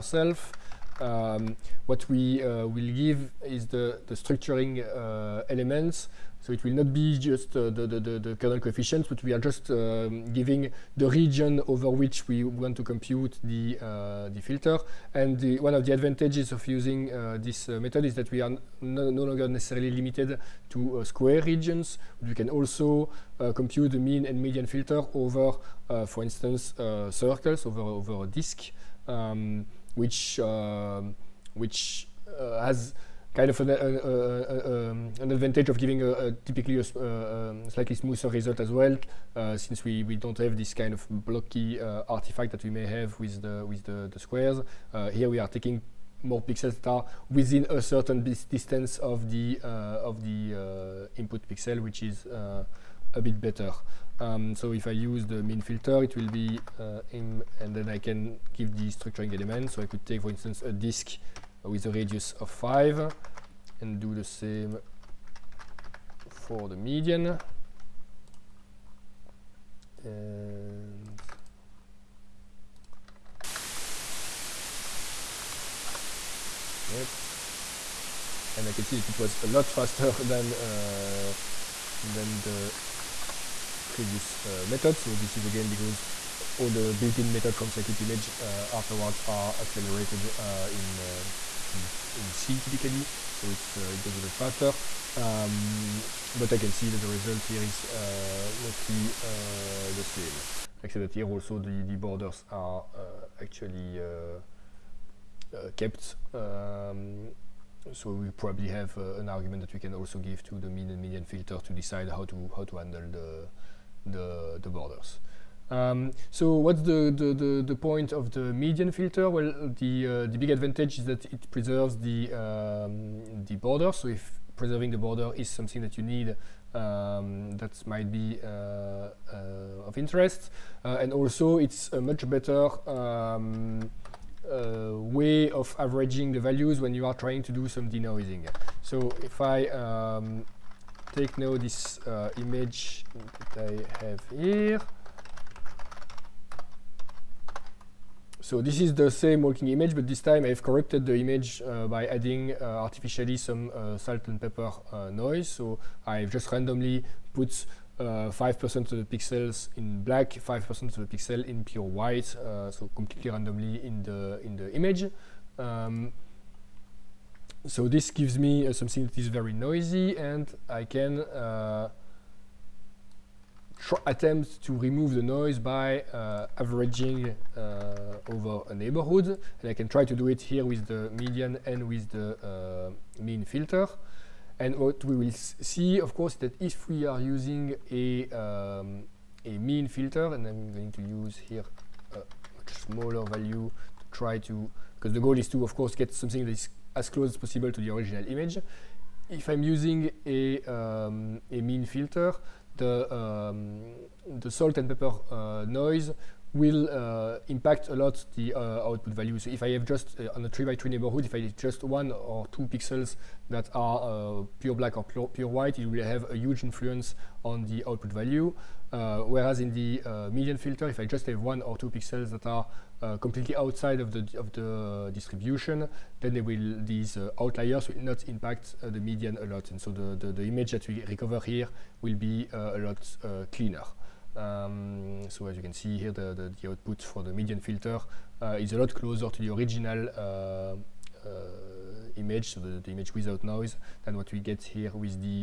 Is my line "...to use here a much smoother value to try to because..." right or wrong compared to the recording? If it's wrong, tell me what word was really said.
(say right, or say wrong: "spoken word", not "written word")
wrong: "smaller", not "smoother".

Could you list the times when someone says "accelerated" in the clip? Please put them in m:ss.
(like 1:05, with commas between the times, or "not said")
1:29.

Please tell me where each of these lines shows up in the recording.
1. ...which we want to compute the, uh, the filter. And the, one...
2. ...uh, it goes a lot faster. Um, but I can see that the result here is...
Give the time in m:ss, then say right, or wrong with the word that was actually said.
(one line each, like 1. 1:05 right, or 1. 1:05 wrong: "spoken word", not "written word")
1. 0:11 right
2. 1:33 right.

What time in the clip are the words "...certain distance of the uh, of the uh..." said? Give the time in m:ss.
0:47.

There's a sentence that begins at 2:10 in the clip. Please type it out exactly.
Uh, and also it's a much better um, uh, way of averaging the values when you are trying to do some denoising.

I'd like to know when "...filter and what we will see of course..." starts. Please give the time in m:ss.
3:03.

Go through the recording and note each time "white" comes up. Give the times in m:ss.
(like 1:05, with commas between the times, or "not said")
2:41, 3:35.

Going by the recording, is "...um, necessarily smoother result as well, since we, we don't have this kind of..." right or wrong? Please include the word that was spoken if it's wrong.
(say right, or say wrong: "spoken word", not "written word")
wrong: "slightly", not "necessarily".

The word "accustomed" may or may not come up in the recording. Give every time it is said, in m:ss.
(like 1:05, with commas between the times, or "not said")
not said.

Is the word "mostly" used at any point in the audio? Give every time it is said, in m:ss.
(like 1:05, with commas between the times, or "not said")
1:38.